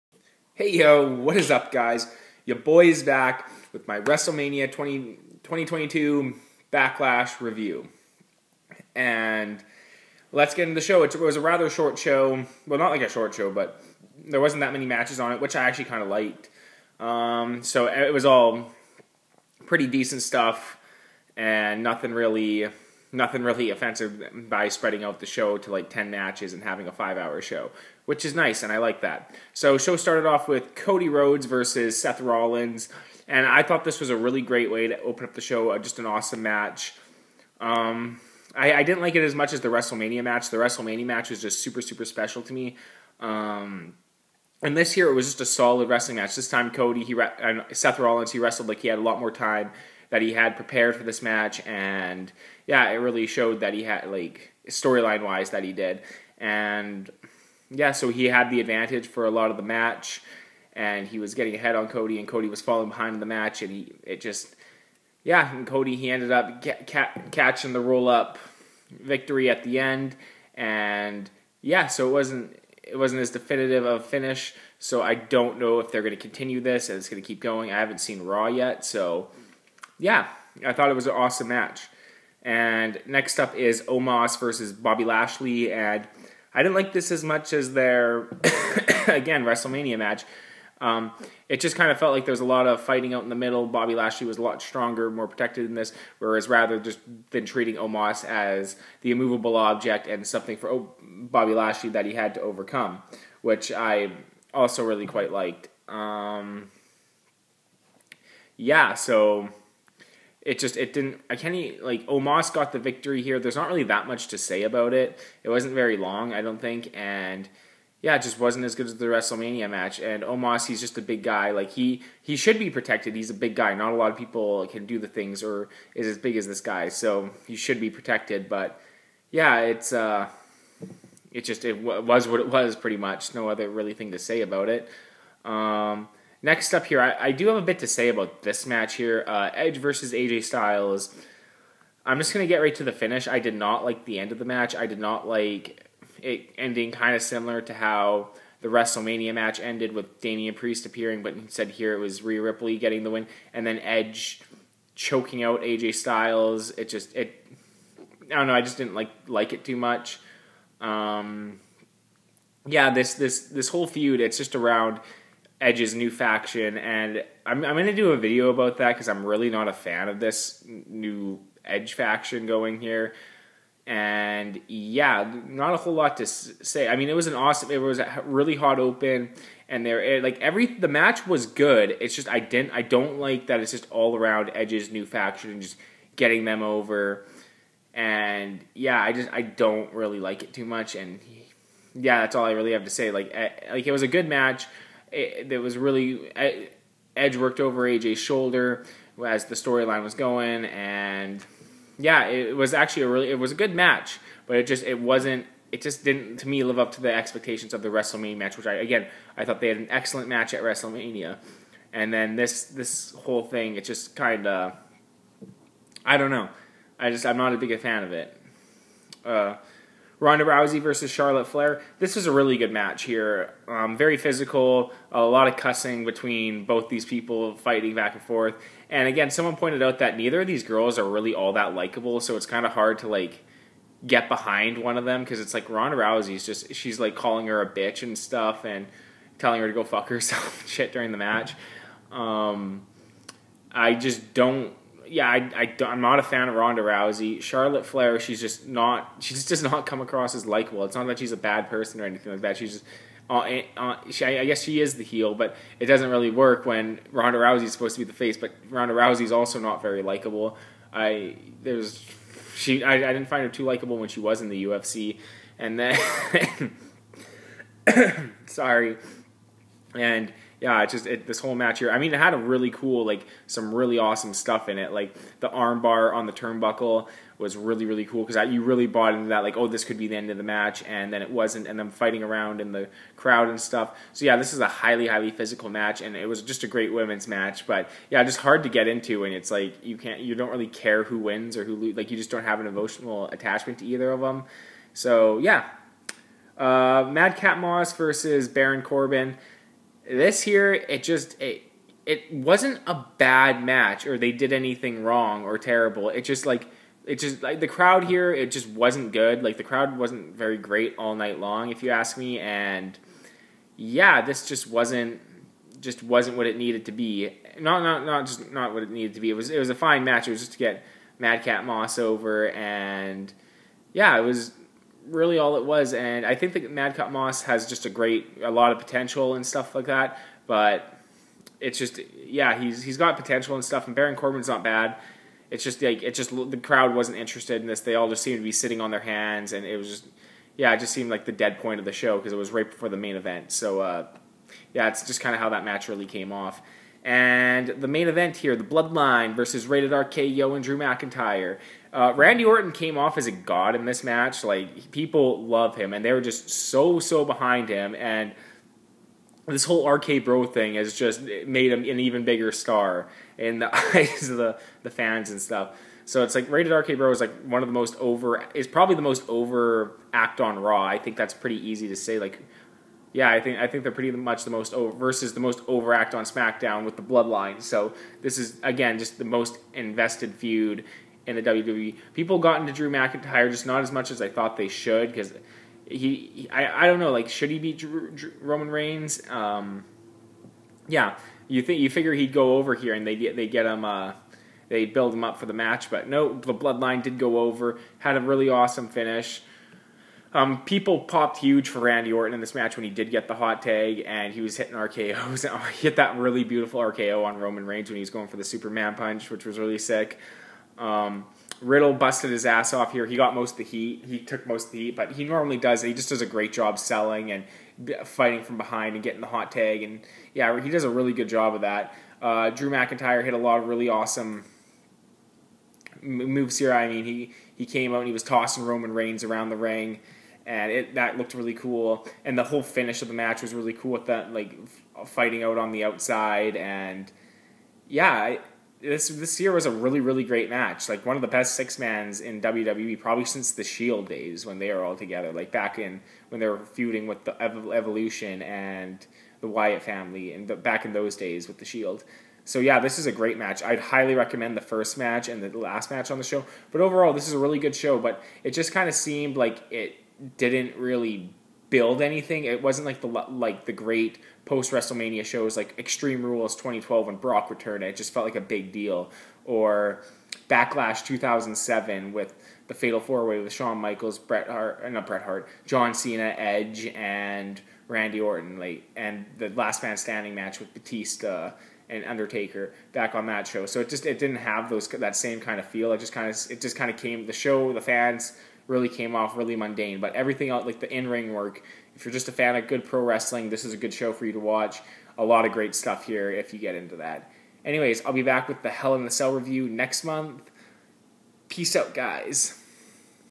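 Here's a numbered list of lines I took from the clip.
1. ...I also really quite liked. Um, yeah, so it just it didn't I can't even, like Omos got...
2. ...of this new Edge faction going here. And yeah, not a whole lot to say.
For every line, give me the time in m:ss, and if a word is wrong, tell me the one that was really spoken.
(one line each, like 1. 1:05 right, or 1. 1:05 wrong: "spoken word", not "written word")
1. 1:43 right
2. 2:50 right.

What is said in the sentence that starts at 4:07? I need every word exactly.
Charlotte Flair, she's just not, she just does not come across as likable.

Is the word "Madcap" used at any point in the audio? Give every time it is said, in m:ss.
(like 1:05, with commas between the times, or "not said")
4:57, 5:21, 5:26.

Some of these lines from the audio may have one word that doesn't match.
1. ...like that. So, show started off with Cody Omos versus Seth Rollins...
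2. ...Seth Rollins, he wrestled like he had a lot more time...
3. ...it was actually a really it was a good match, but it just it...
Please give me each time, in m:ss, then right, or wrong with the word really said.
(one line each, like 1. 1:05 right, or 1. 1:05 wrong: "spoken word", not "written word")
1. 0:28 wrong: "Rhodes", not "Omos"
2. 0:47 right
3. 3:22 right.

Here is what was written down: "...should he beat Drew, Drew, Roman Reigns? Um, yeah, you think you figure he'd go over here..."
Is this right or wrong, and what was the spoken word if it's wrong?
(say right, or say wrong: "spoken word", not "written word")
right.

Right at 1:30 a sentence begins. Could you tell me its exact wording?
Um, it just kind of felt like there was a lot of fighting out in the middle.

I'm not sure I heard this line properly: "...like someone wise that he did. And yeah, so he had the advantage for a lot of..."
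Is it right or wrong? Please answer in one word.
wrong.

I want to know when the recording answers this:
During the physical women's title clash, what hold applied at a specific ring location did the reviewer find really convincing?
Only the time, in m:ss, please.
4:35.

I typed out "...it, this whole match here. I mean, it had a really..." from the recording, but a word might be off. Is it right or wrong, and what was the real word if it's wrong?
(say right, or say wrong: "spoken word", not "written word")
right.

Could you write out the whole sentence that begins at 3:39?
Uh, Ronda Rousey versus Charlotte Flair.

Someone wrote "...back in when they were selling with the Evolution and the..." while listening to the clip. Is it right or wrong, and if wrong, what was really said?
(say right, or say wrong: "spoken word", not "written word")
wrong: "feuding", not "selling".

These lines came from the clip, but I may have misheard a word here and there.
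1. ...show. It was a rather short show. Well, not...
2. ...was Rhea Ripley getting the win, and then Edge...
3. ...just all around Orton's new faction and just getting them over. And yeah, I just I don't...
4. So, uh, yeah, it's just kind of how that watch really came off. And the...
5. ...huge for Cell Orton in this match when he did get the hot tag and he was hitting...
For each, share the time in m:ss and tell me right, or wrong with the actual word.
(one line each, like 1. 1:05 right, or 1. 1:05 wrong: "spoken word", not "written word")
1. 0:10 right
2. 2:31 right
3. 3:03 wrong: "Edge", not "Orton"
4. 5:43 wrong: "match", not "watch"
5. 6:41 wrong: "Randy", not "Cell".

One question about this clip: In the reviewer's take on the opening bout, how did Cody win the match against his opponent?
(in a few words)
Roll up.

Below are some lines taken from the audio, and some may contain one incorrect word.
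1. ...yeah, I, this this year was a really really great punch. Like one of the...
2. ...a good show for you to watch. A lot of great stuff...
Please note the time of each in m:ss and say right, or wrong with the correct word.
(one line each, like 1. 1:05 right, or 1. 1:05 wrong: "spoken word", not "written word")
1. 7:17 wrong: "match", not "punch"
2. 8:13 right.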